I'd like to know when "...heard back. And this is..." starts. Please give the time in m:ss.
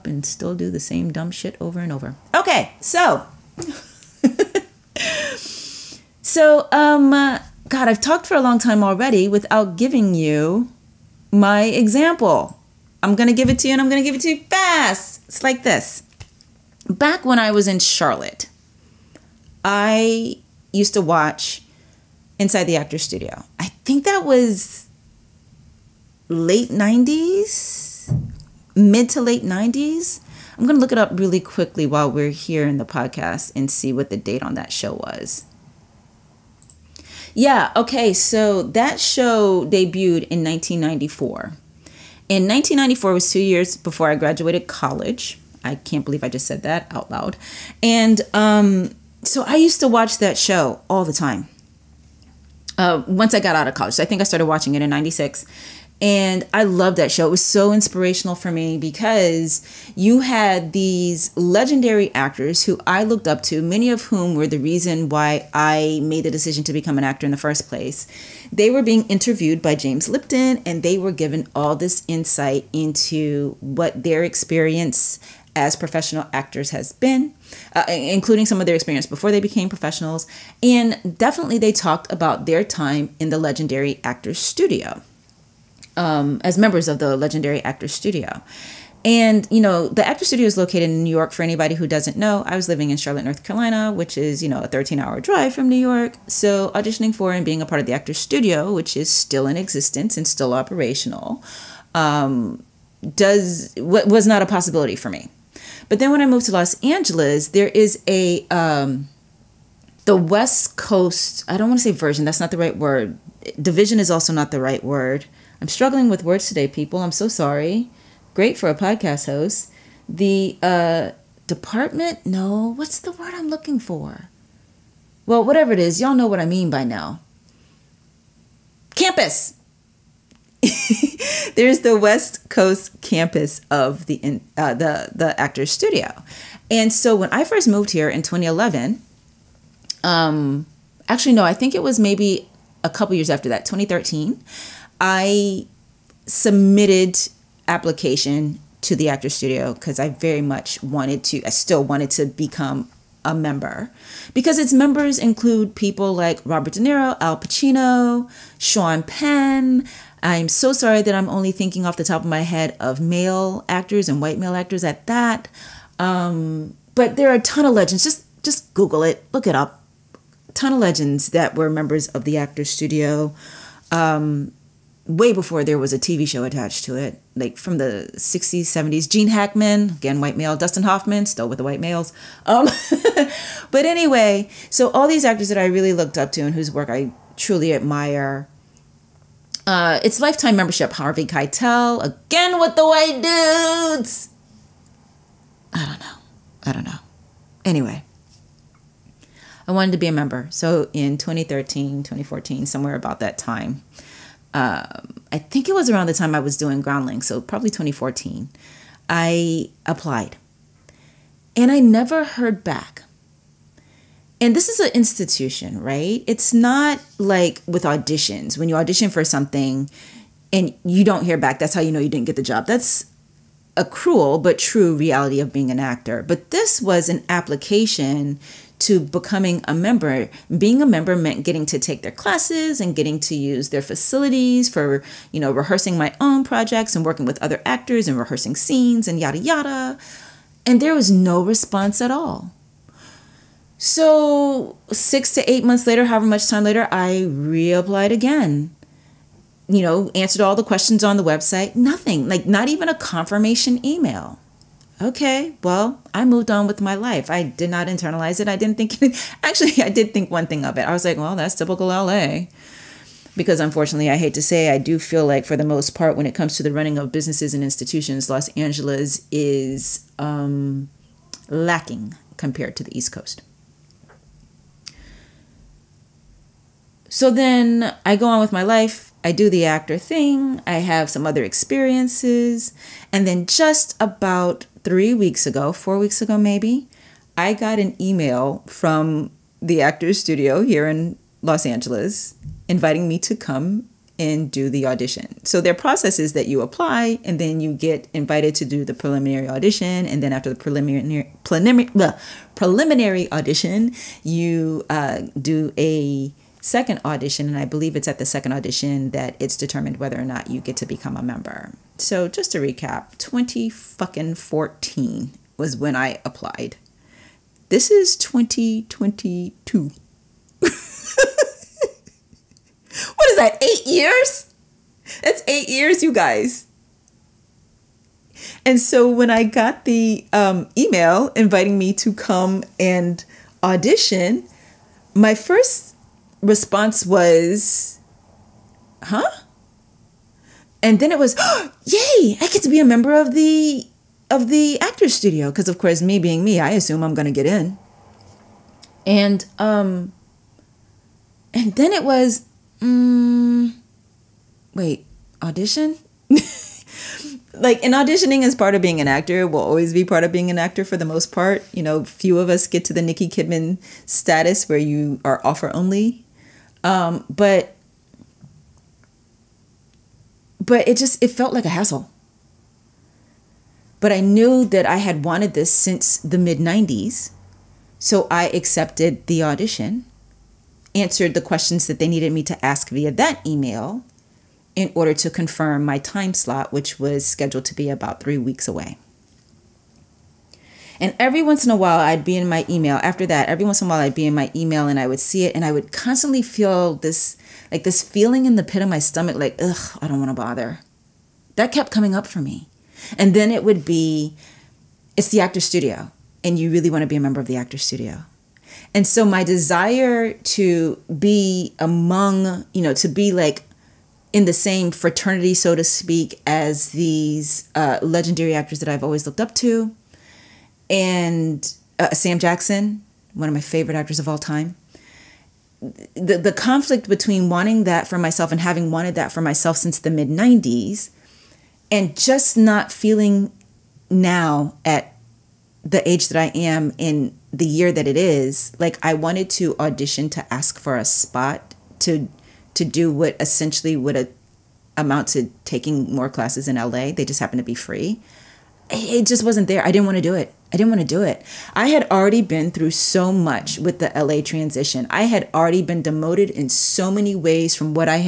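3:32.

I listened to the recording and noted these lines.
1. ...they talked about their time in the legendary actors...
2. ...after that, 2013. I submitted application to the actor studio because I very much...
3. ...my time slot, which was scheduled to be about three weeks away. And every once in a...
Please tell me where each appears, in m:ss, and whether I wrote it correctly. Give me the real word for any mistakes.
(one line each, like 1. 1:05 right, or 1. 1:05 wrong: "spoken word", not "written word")
1. 1:21 right
2. 2:23 right
3. 6:25 right.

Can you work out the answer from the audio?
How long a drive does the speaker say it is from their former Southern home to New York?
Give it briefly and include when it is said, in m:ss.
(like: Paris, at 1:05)
13 hours, at 1:34.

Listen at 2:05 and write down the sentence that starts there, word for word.
Well, whatever it is, y'all know what I mean by now.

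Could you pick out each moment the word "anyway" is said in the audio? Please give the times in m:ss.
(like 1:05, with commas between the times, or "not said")
3:03, 3:17.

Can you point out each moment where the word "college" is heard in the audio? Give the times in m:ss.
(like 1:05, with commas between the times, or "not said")
0:44, 0:53.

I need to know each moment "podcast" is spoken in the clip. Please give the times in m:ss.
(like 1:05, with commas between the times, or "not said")
0:32, 1:58.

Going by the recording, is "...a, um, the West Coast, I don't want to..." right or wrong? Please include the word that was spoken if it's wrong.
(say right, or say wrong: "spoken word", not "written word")
right.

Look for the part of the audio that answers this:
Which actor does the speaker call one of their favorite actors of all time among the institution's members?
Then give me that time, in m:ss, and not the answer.
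7:02.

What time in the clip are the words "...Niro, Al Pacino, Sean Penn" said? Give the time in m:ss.
2:36.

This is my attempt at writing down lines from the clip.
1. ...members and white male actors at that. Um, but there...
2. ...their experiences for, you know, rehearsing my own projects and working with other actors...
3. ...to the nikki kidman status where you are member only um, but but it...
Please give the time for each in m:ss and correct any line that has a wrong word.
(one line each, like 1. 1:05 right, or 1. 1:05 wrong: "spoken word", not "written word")
1. 2:43 wrong: "actors", not "members"
2. 3:53 wrong: "facilities", not "experiences"
3. 6:02 wrong: "offer", not "member".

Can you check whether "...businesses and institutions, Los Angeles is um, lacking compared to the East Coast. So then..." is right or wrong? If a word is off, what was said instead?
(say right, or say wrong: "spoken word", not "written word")
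right.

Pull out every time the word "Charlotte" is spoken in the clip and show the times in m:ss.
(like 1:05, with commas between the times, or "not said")
0:17, 1:32.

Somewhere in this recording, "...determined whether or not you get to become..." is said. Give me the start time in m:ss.
5:09.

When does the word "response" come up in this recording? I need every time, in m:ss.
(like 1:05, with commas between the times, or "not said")
4:01, 5:36.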